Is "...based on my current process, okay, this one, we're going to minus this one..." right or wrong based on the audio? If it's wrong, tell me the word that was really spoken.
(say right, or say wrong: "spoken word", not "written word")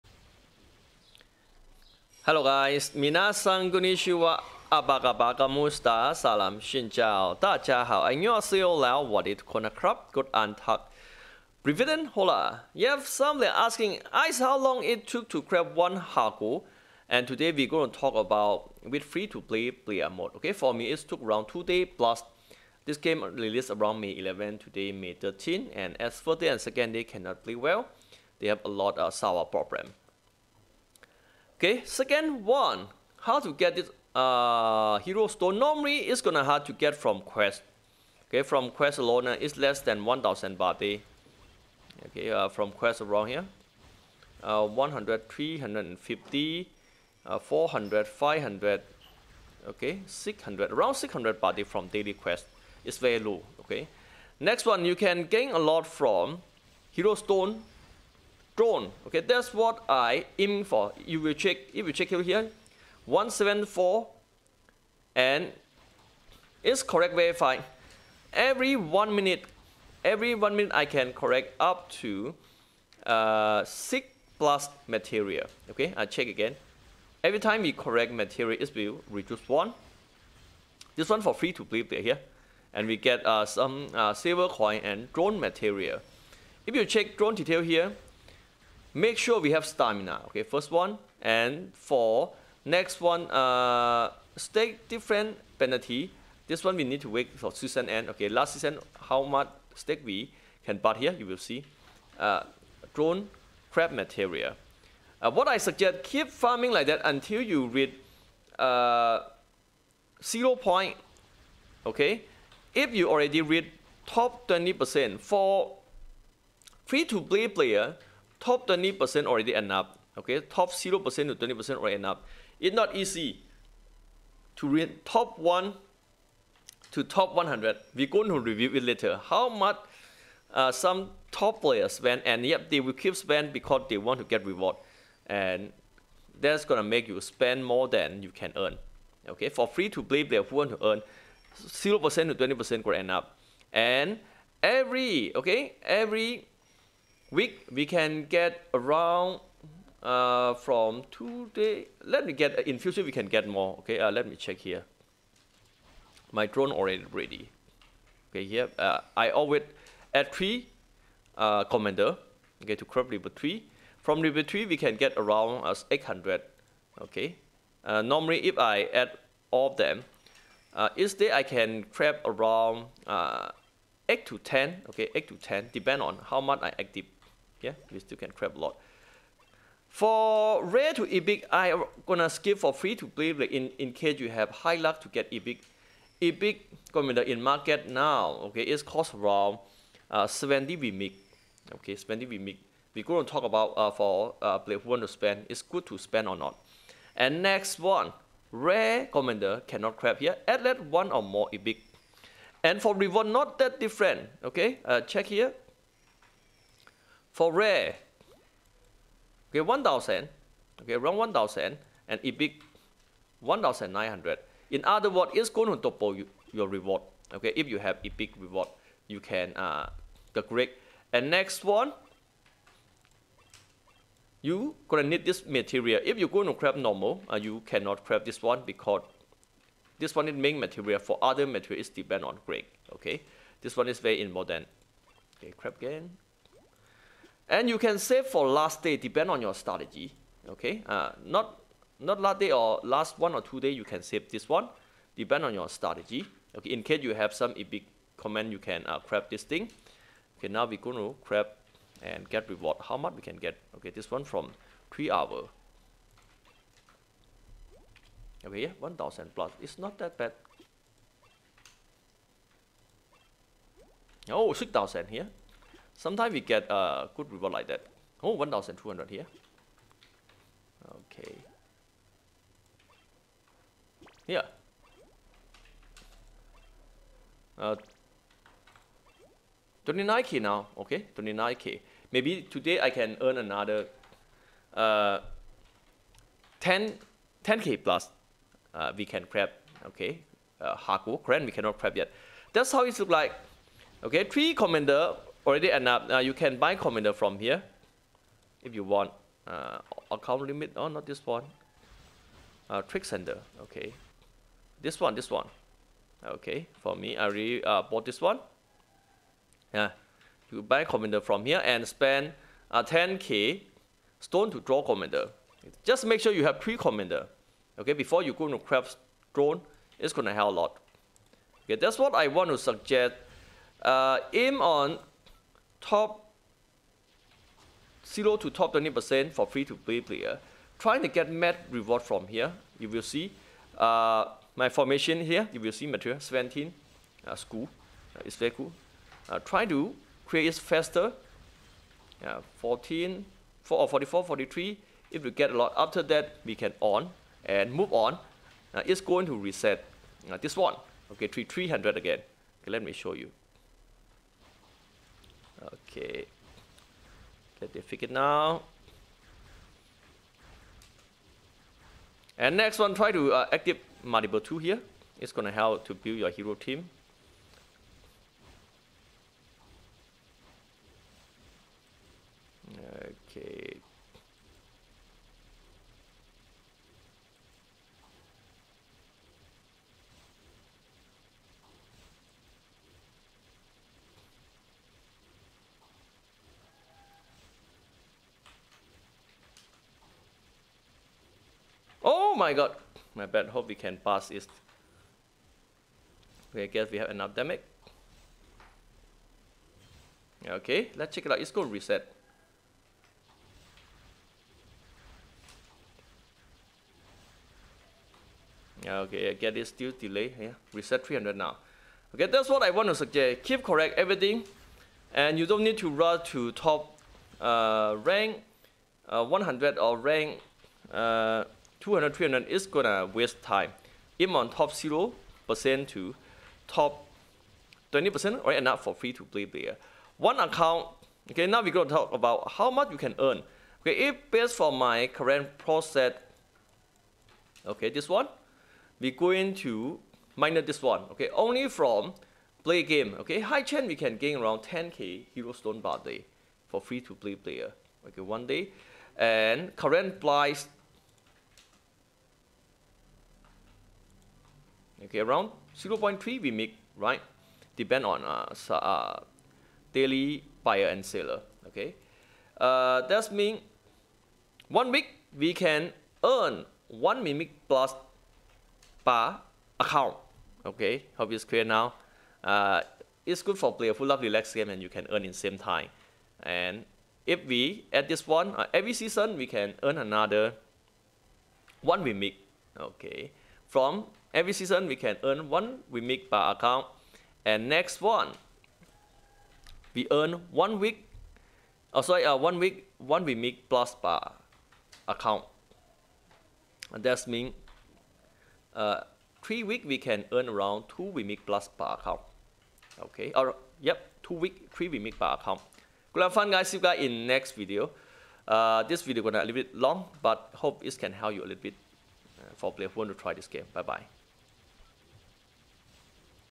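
right.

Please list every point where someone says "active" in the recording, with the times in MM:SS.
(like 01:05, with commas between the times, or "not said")
02:56, 06:03.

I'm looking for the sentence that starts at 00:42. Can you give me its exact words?
Okay, uh, from quest around here.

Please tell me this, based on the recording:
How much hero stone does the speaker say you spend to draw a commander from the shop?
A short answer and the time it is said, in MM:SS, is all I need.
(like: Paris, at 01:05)
10k, at 05:12.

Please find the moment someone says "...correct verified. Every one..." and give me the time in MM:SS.
01:06.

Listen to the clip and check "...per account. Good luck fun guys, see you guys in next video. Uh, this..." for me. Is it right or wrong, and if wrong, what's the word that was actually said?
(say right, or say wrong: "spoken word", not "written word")
right.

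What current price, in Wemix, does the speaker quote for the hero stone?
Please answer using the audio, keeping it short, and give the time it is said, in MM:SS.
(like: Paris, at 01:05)
0.3 Wemix, at 07:35.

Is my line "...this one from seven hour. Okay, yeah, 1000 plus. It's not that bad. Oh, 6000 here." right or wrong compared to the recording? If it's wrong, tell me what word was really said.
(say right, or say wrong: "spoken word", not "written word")
wrong: "three", not "seven".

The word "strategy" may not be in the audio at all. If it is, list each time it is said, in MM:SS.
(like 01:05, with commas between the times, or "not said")
03:59, 04:05.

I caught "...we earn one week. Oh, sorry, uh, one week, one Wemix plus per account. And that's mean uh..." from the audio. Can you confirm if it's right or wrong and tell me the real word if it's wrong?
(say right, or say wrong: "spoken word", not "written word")
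right.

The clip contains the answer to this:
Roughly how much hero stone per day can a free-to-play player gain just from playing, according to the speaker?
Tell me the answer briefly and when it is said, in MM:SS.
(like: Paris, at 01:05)
10k, at 07:24.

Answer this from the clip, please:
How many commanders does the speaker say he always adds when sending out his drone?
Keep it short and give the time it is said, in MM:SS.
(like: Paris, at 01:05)
3, at 02:40.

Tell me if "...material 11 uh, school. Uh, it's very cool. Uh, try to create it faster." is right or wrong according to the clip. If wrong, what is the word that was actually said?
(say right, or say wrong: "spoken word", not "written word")
wrong: "17", not "11".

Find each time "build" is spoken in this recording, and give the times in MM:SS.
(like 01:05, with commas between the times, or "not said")
06:05.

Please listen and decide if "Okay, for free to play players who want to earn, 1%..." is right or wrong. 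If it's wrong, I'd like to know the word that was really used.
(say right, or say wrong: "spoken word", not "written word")
wrong: "0", not "1".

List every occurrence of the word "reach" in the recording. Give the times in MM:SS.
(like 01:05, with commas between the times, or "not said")
01:47, 01:53.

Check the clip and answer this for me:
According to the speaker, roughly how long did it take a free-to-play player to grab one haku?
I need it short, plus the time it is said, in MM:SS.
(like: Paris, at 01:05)
2 days, at 00:21.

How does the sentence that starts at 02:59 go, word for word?
For rare to Epic, I'm gonna skip for free to play like in, in case you have high luck to get Epic.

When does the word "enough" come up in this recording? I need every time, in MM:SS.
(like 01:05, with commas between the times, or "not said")
04:55, 07:08.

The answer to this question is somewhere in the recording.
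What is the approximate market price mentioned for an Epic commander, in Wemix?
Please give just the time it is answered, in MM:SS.
03:10.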